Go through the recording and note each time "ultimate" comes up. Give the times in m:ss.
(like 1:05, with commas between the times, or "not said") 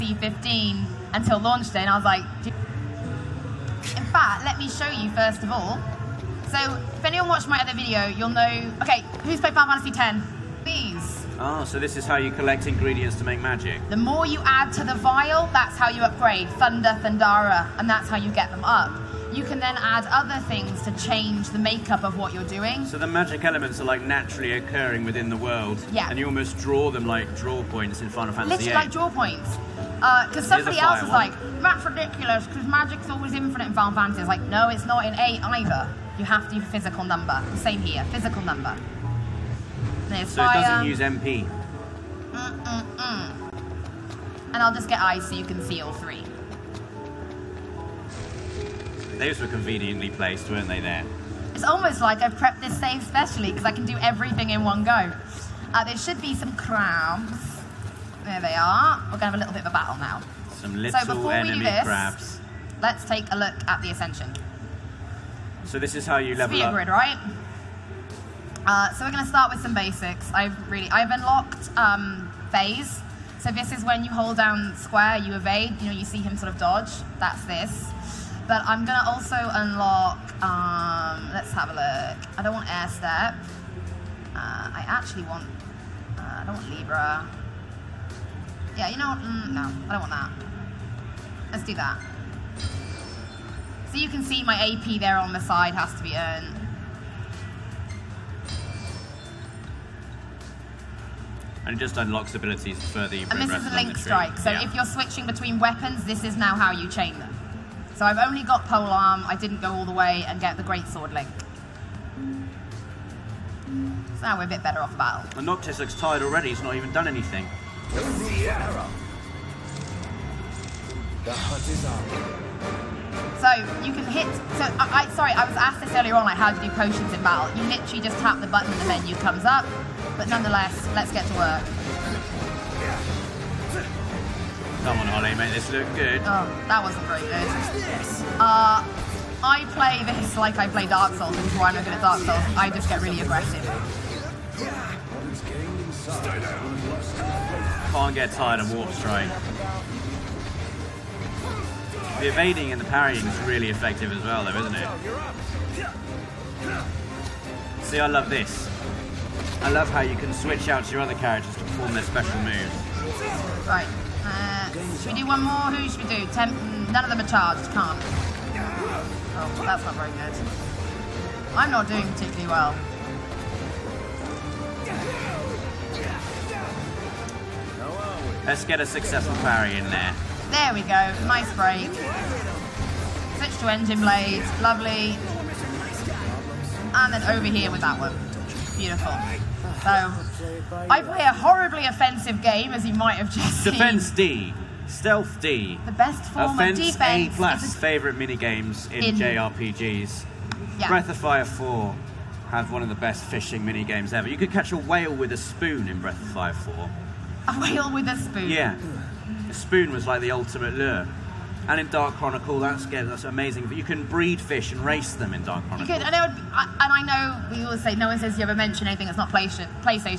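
3:30.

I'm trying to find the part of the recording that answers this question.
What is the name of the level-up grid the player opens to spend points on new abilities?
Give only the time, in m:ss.
1:03.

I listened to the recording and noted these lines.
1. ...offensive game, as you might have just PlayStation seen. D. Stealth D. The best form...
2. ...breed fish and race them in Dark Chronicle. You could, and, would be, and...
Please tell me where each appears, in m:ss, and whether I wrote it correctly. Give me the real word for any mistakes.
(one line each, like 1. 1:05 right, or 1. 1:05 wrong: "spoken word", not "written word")
1. 3:11 wrong: "Defense", not "PlayStation"
2. 3:34 right.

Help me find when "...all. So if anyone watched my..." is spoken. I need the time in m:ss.
0:05.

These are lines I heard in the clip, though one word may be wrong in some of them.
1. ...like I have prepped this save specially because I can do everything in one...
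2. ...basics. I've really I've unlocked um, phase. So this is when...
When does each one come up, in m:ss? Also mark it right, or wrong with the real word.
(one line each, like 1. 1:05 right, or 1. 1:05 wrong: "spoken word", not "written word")
1. 0:52 right
2. 1:09 right.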